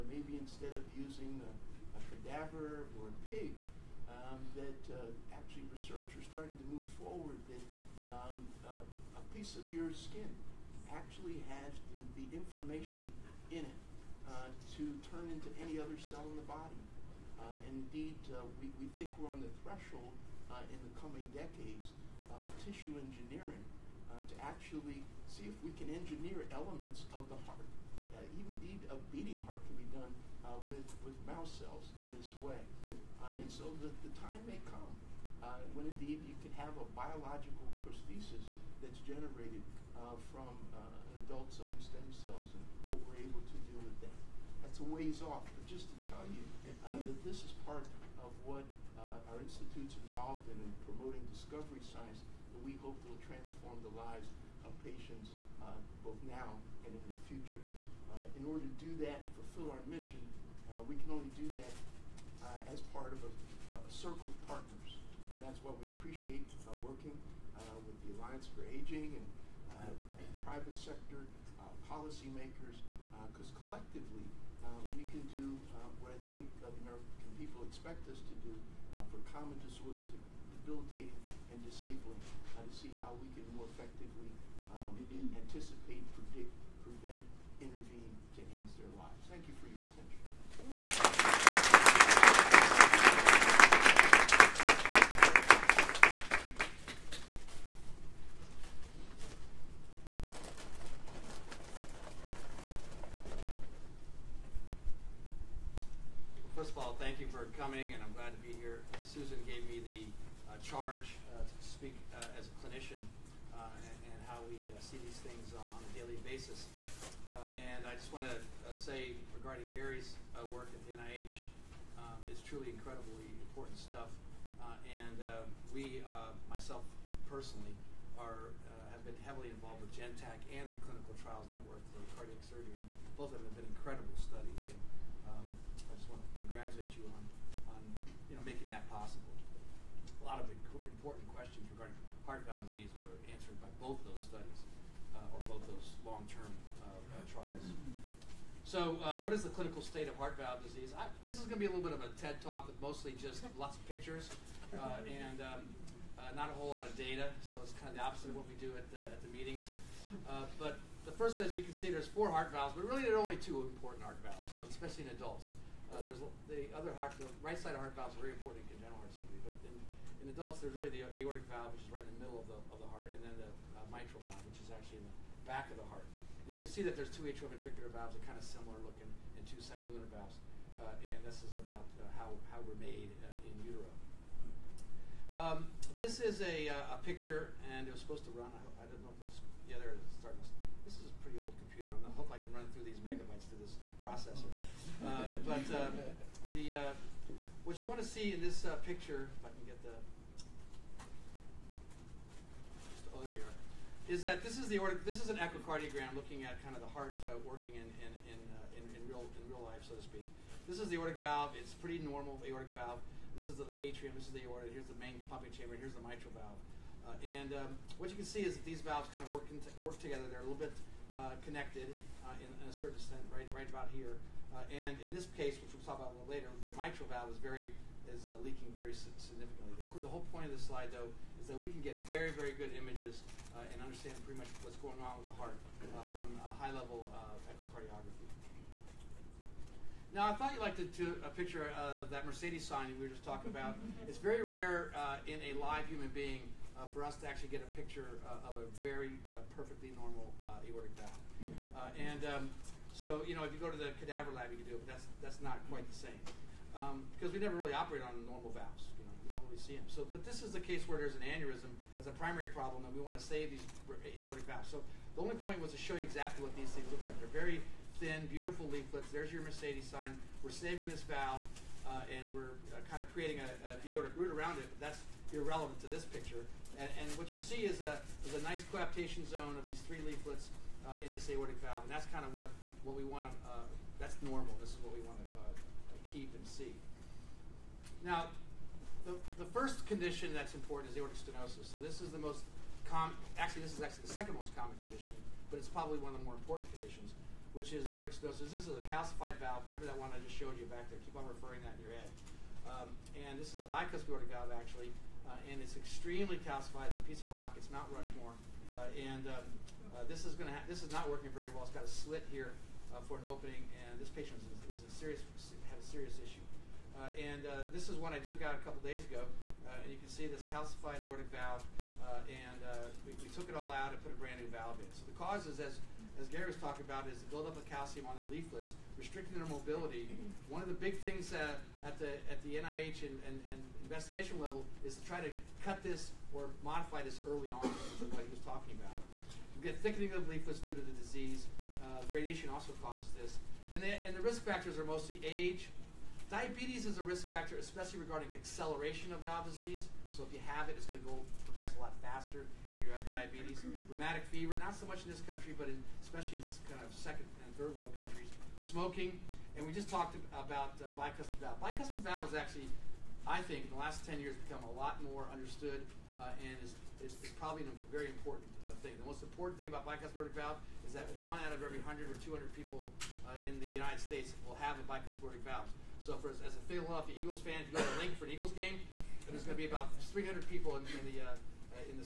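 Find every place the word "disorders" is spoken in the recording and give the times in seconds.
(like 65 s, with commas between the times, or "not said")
79 s.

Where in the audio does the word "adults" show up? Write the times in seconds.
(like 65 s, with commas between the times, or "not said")
41 s, 165 s, 170 s.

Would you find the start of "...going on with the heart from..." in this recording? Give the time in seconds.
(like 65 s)
234 s.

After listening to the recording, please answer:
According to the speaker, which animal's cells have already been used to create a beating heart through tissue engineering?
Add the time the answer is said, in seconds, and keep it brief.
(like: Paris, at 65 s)
mouse, at 31 s.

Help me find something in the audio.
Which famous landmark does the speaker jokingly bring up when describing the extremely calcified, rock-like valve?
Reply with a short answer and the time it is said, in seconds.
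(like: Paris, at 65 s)
Rushmore, at 307 s.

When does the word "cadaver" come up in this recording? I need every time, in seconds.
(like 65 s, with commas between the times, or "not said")
2 s, 253 s.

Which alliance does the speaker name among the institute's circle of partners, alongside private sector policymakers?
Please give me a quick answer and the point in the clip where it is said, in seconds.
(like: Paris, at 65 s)
Alliance for Aging, at 68 s.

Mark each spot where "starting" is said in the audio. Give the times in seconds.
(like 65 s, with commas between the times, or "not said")
6 s, 190 s.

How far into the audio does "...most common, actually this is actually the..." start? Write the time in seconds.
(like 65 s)
292 s.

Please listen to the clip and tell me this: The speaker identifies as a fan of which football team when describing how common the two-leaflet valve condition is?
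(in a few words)
Philadelphia Eagles.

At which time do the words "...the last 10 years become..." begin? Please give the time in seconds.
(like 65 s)
363 s.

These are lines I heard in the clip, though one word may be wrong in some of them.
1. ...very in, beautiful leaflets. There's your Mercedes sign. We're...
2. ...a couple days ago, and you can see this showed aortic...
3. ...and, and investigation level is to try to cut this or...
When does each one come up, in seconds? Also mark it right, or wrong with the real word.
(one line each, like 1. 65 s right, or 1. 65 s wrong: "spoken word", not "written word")
1. 267 s right
2. 318 s wrong: "calcified", not "showed"
3. 333 s right.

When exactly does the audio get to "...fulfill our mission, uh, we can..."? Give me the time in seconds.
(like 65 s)
59 s.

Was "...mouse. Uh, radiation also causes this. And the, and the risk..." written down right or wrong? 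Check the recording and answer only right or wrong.
wrong.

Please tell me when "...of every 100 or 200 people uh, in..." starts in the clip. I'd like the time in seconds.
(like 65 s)
371 s.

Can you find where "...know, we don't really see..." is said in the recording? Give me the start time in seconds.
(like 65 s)
259 s.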